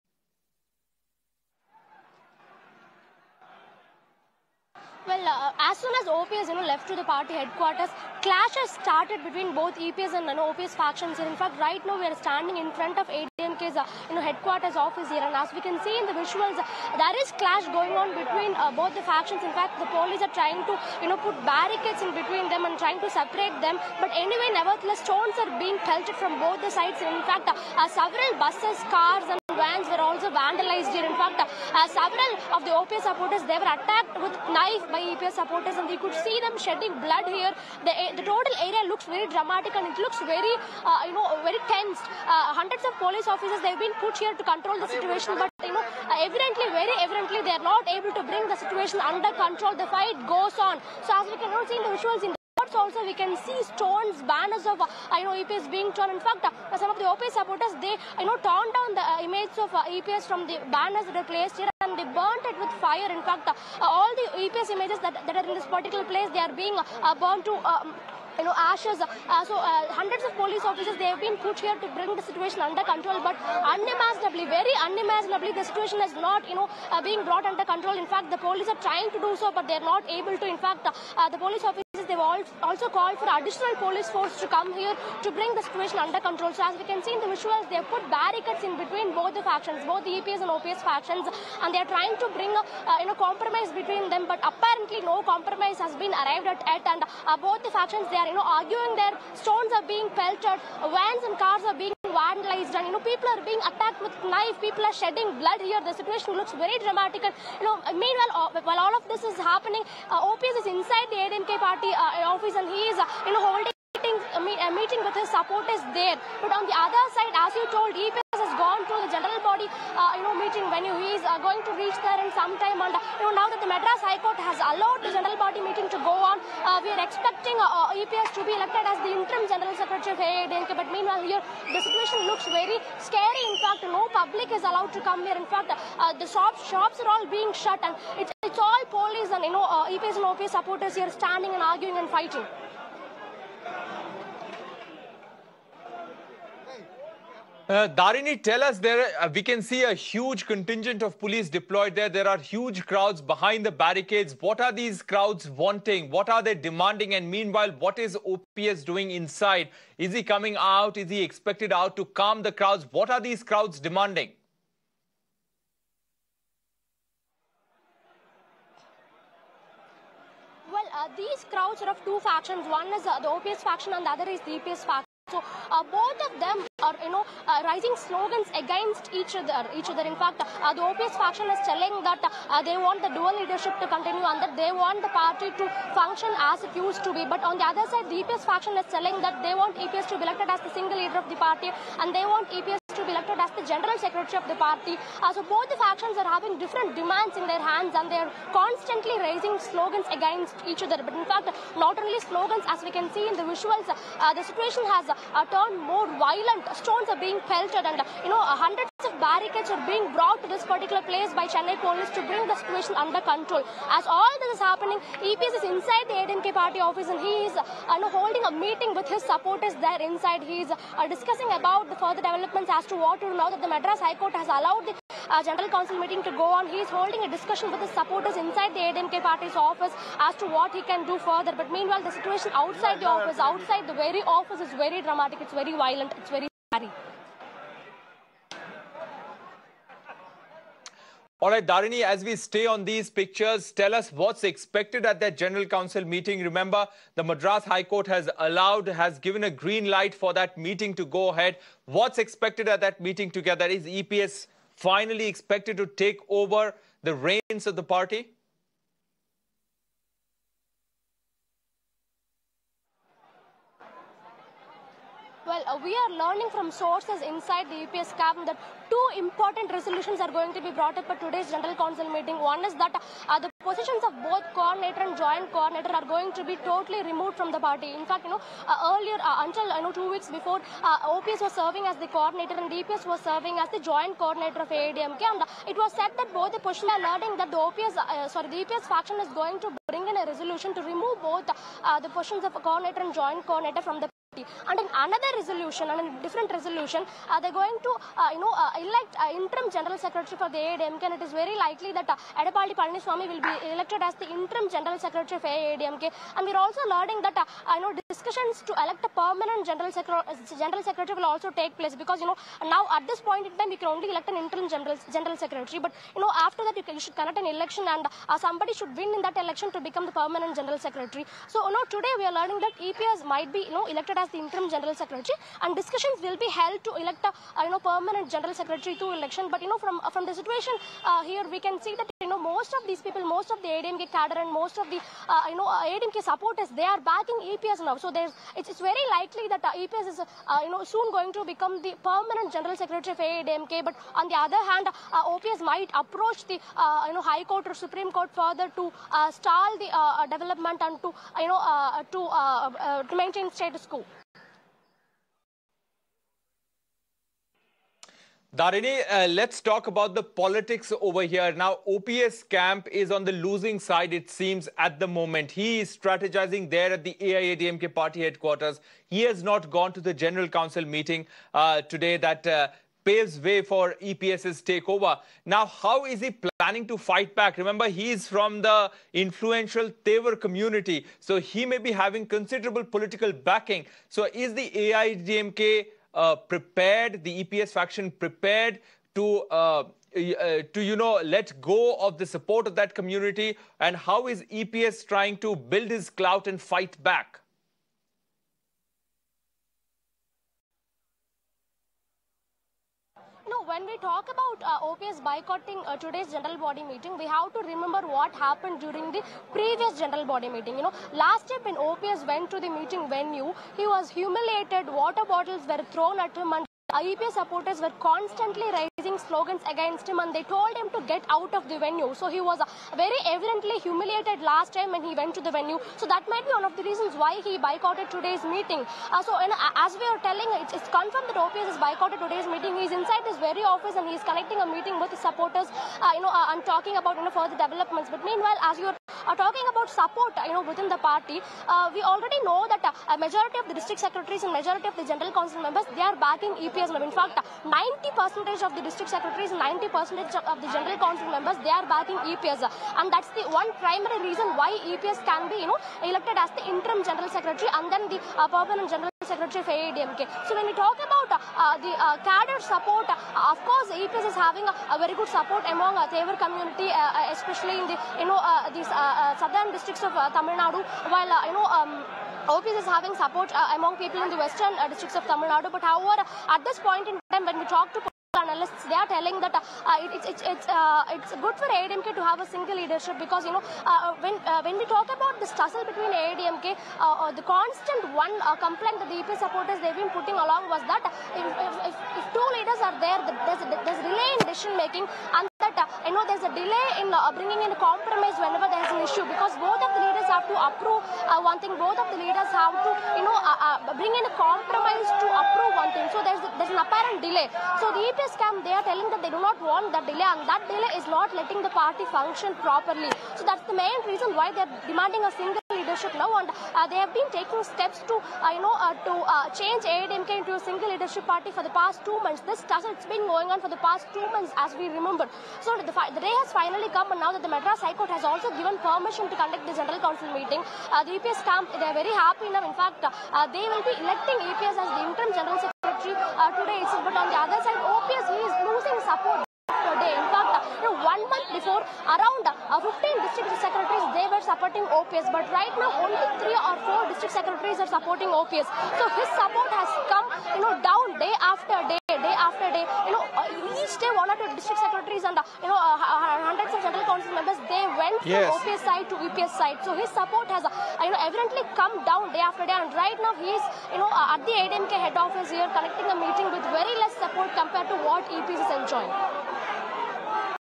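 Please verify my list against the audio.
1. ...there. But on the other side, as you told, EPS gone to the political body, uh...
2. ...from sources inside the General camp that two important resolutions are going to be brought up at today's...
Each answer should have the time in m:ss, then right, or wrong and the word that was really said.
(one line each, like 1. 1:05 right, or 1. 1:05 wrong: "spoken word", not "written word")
1. 1:55 wrong: "general", not "political"
2. 4:26 wrong: "EPS", not "General".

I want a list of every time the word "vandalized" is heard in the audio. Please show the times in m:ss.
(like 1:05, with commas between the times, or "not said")
0:30, 1:42.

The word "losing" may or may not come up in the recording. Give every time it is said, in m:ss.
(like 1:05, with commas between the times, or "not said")
6:03, 8:58.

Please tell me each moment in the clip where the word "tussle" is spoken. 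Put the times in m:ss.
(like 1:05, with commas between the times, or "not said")
8:05, 8:42.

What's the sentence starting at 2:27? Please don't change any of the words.
Uh, Darini, tell us there, uh, we can see a huge contingent of police deployed there.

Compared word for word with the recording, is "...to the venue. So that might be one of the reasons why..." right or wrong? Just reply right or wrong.
right.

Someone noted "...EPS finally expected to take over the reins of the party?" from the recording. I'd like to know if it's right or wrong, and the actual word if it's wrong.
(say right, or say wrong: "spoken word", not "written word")
right.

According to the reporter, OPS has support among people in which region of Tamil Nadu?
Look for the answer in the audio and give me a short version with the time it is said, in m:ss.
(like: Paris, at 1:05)
Western districts, at 7:54.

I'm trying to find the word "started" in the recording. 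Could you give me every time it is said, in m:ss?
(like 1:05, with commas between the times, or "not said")
0:08.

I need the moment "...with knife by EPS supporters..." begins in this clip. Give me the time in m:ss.
0:34.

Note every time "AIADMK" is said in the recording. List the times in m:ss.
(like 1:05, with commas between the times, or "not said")
2:10, 5:00, 5:05, 6:07, 6:24.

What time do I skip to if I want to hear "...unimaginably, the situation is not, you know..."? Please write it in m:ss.
1:14.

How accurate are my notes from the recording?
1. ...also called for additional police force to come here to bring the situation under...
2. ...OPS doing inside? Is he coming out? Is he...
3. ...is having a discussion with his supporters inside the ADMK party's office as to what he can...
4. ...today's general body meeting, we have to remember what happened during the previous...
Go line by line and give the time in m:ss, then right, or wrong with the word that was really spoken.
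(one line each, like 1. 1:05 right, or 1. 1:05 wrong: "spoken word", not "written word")
1. 1:22 right
2. 2:38 right
3. 3:46 wrong: "holding", not "having"
4. 6:45 right.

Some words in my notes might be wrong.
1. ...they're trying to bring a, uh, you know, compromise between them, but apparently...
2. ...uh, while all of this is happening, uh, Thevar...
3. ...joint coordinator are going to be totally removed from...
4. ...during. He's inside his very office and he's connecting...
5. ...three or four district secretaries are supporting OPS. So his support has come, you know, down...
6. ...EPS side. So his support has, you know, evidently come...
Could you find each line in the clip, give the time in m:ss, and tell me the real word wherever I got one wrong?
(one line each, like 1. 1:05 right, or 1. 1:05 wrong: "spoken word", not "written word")
1. 1:31 right
2. 1:48 wrong: "OPS", not "Thevar"
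3. 4:35 right
4. 7:12 wrong: "meeting", not "during"
5. 9:06 right
6. 9:19 right.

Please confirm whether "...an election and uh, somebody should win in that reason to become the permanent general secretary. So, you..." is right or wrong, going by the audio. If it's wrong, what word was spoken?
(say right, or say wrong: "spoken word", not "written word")
wrong: "election", not "reason".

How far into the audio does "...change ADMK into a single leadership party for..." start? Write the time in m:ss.
8:39.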